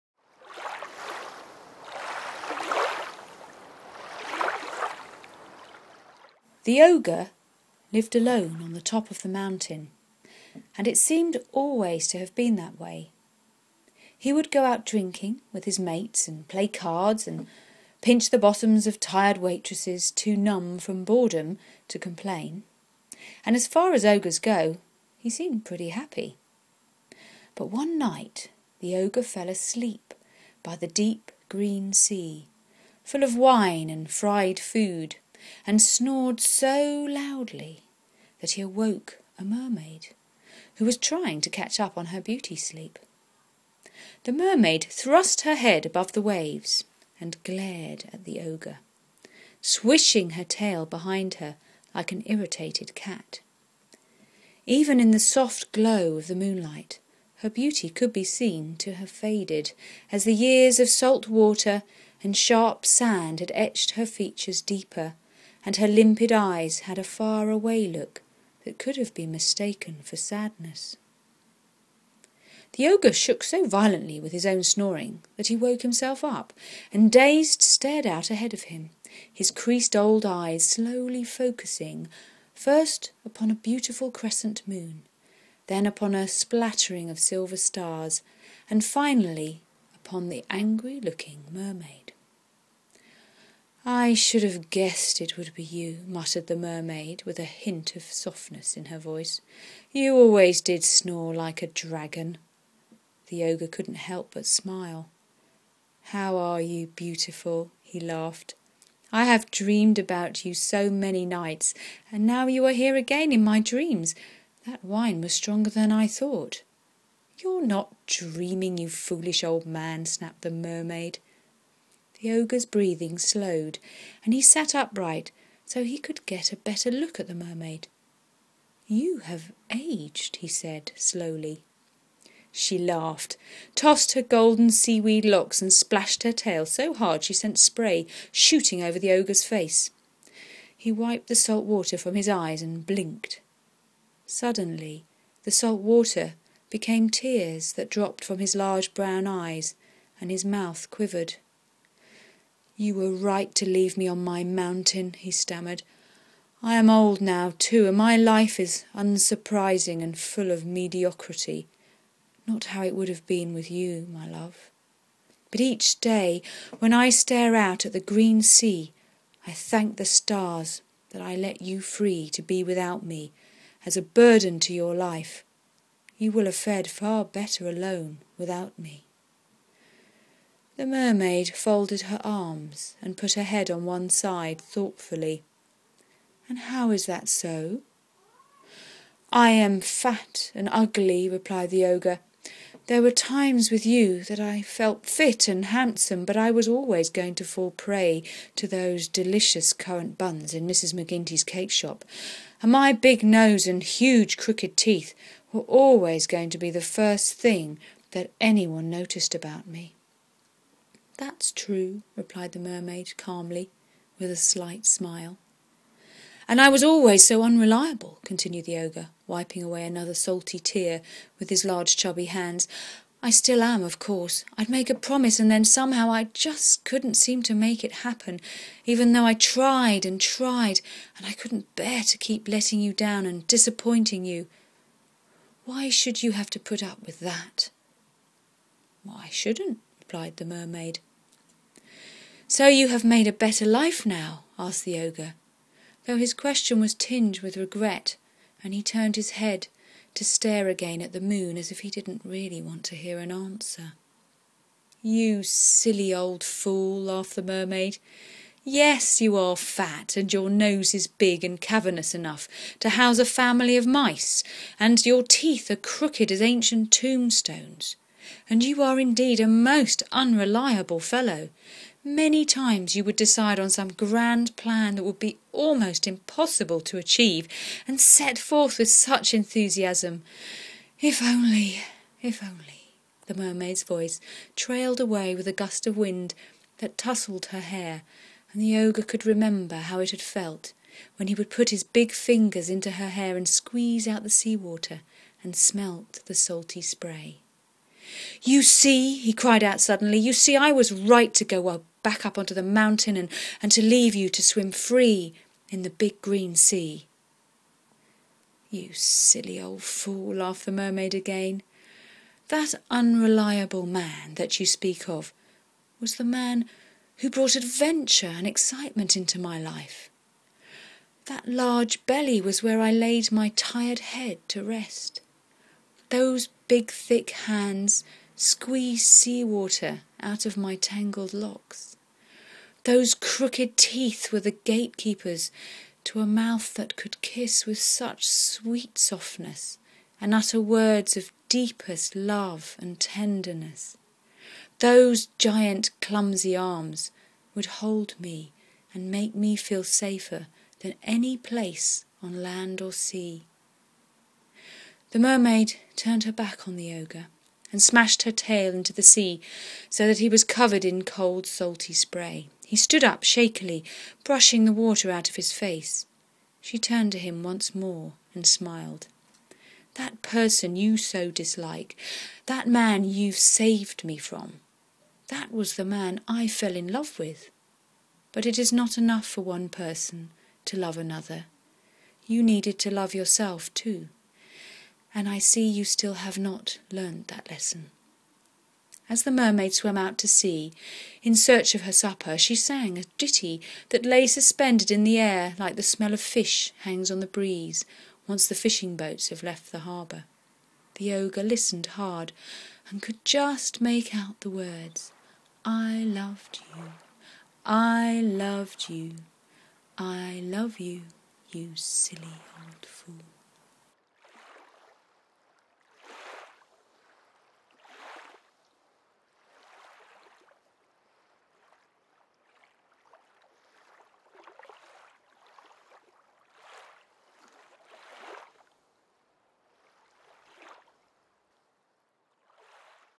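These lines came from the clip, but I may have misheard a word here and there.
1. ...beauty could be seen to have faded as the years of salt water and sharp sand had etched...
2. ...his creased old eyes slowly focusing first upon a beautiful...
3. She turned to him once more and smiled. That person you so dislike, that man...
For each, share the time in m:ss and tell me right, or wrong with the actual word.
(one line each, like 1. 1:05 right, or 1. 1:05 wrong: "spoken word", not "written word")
1. 0:57 right
2. 1:19 right
3. 6:06 right.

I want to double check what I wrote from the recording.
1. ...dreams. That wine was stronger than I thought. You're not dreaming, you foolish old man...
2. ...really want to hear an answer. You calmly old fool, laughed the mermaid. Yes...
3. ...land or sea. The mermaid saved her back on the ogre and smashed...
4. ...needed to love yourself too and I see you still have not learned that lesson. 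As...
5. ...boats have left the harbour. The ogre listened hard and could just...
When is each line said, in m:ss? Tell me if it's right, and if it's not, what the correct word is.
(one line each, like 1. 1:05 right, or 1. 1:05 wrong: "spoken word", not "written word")
1. 1:53 right
2. 4:12 wrong: "silly", not "calmly"
3. 5:52 wrong: "turned", not "saved"
4. 6:22 right
5. 6:38 right.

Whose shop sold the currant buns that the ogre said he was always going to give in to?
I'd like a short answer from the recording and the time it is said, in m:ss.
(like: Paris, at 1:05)
Mrs. McGinty's, at 3:20.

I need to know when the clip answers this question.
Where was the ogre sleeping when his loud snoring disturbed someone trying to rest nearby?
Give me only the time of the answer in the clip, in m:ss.
0:30.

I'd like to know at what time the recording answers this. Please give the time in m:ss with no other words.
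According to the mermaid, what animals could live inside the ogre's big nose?
4:23.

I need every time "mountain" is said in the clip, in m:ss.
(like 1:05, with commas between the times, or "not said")
0:09, 2:34, 5:02.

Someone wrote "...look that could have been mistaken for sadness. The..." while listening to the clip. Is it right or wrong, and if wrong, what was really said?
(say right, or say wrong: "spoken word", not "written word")
right.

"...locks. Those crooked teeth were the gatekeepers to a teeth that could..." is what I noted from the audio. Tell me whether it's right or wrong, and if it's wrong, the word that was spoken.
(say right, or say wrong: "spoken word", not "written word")
wrong: "mouth", not "teeth".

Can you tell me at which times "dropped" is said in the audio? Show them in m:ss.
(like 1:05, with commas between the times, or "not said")
2:27.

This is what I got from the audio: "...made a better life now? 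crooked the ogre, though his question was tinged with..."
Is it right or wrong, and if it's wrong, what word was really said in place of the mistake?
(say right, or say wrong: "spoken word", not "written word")
wrong: "asked", not "crooked".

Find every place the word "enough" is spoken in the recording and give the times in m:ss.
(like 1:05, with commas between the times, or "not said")
4:22, 6:18.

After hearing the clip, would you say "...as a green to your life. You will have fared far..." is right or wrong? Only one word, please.
wrong.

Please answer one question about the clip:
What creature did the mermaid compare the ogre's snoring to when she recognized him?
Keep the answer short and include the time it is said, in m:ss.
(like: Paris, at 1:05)
a dragon, at 1:41.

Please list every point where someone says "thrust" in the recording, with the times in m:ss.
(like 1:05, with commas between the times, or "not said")
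0:44.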